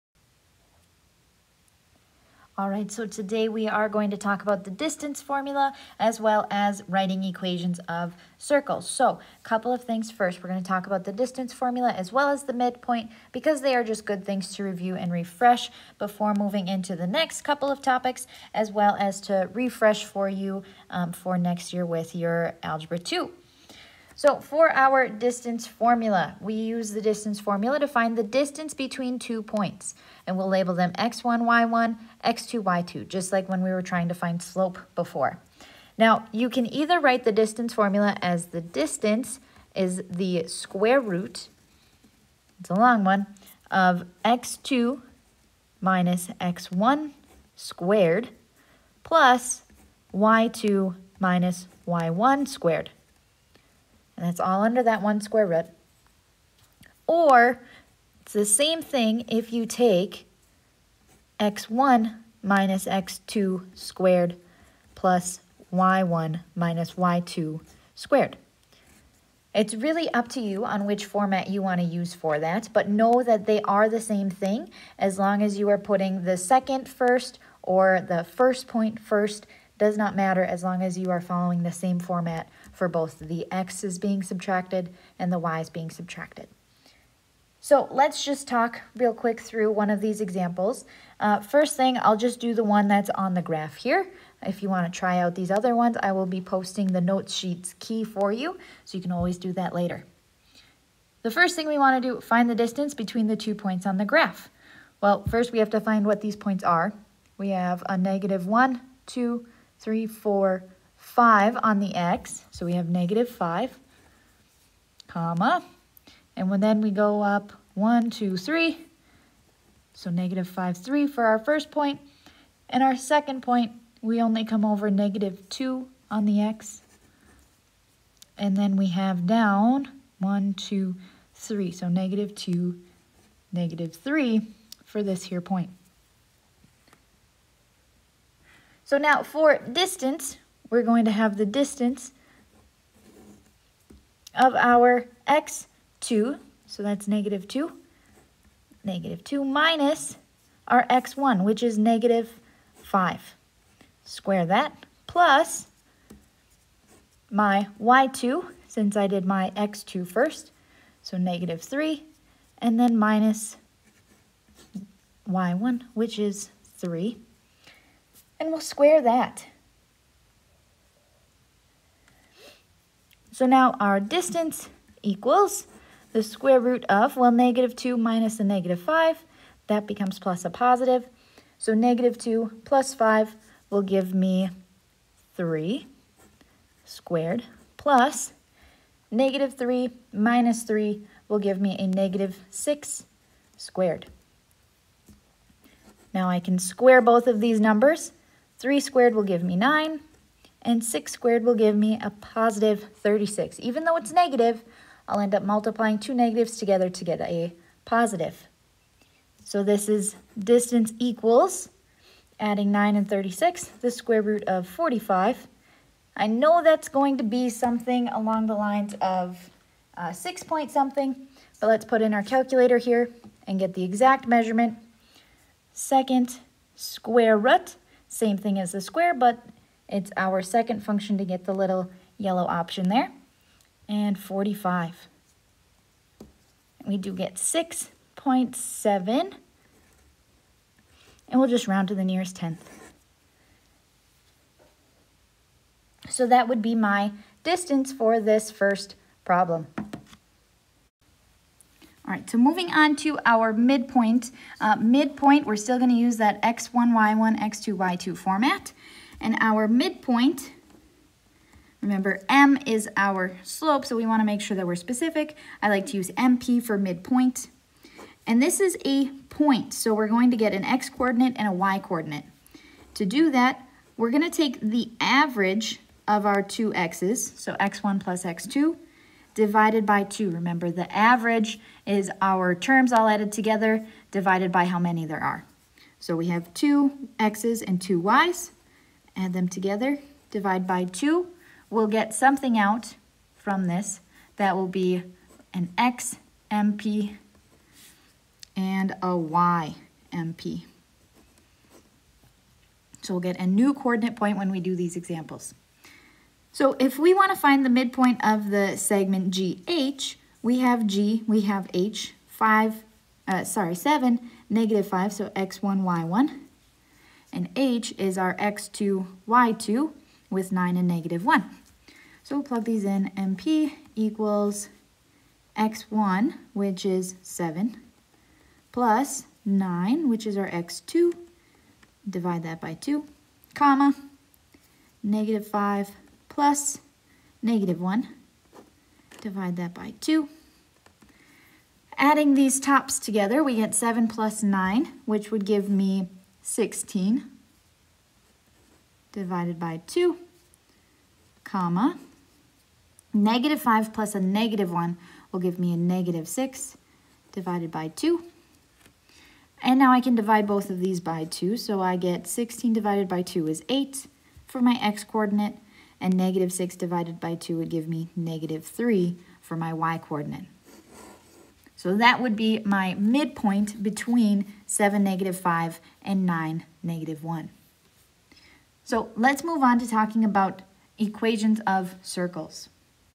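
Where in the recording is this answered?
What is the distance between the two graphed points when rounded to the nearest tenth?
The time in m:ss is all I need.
3:57.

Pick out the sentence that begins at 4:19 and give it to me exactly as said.
And our midpoint, remember M is our slope, so we wanna make sure that we're specific.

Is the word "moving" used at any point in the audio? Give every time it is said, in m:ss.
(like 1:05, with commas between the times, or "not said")
0:16, 4:12.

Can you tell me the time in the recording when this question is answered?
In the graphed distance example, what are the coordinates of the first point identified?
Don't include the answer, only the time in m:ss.
2:00.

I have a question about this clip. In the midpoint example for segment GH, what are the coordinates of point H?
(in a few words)
(9, -1).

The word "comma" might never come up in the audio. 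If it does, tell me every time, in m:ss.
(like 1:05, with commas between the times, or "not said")
1:55, 5:33, 5:51.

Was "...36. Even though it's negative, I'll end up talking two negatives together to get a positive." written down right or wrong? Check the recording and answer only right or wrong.
wrong.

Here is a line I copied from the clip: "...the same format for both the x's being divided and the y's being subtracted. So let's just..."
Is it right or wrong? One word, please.
wrong.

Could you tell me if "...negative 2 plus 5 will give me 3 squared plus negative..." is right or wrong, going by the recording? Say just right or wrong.
right.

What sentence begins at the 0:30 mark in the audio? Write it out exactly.
And we'll label them x1, y1, x2, y2, just like when we were trying to find slope before.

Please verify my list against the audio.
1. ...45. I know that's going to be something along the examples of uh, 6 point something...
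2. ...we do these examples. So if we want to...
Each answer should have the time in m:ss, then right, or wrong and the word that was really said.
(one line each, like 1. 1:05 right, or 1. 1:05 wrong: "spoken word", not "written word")
1. 3:34 wrong: "lines", not "examples"
2. 5:04 right.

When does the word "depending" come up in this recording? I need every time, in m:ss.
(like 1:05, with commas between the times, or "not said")
not said.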